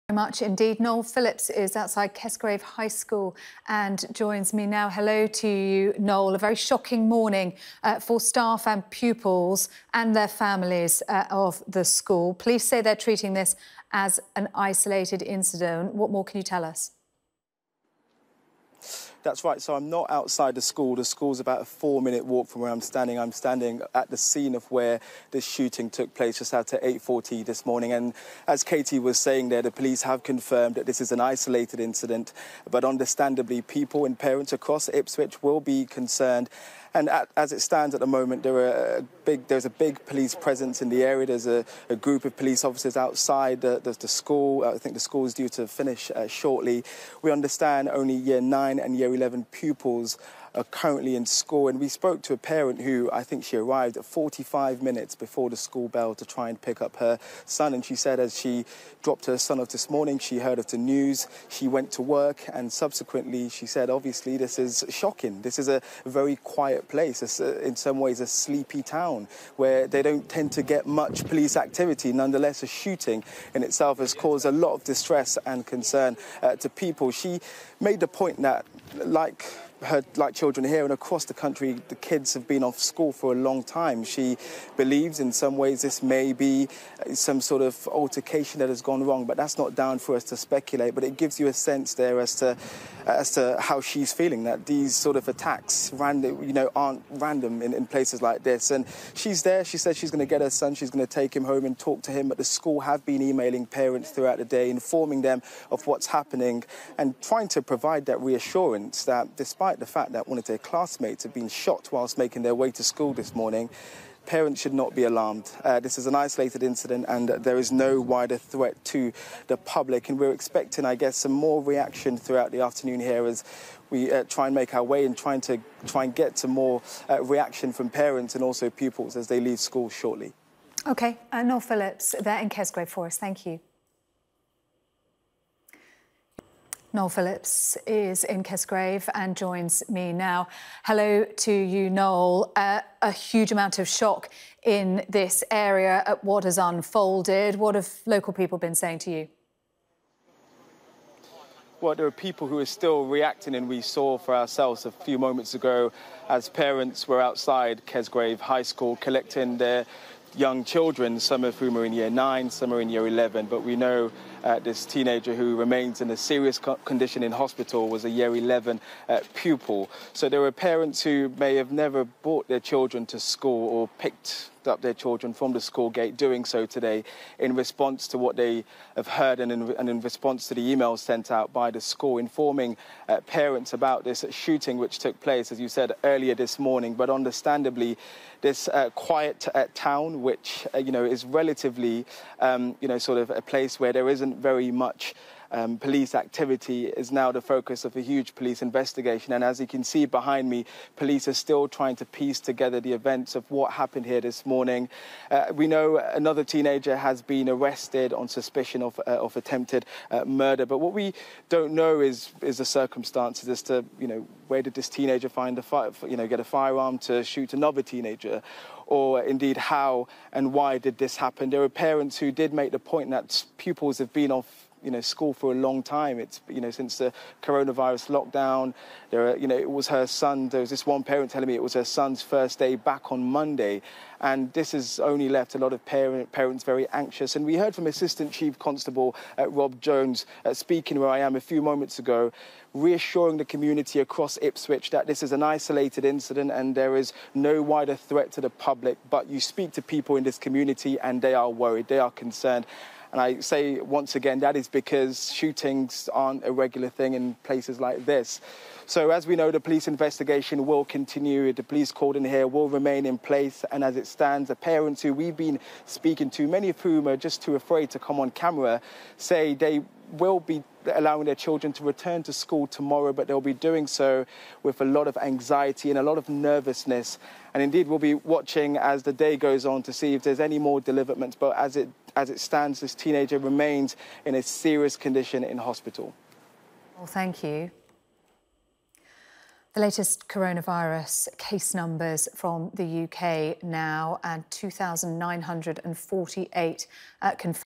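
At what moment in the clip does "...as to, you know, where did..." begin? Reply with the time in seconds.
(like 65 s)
213 s.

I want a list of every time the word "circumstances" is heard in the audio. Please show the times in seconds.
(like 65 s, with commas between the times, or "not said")
212 s.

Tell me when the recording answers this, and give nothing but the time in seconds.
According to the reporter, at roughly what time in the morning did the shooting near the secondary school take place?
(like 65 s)
26 s.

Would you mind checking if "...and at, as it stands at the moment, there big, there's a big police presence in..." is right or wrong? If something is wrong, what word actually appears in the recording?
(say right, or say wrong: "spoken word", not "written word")
right.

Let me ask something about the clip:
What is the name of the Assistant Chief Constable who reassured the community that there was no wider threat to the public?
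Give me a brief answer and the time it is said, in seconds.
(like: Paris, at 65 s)
Rob Jones, at 239 s.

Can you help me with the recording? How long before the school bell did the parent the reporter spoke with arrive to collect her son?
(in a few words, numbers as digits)
45 minutes.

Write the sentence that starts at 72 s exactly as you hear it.
Nonetheless, a shooting in itself has caused a lot of distress and concern uh, to people.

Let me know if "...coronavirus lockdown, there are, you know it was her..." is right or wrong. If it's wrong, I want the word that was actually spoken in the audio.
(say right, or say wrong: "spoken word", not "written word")
right.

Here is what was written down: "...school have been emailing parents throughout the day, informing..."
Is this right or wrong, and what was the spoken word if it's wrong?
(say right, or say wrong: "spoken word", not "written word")
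right.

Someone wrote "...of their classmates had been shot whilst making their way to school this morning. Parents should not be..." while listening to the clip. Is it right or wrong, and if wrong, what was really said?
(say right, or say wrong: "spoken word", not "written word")
right.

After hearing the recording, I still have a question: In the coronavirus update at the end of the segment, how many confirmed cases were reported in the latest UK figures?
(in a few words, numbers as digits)
2,948.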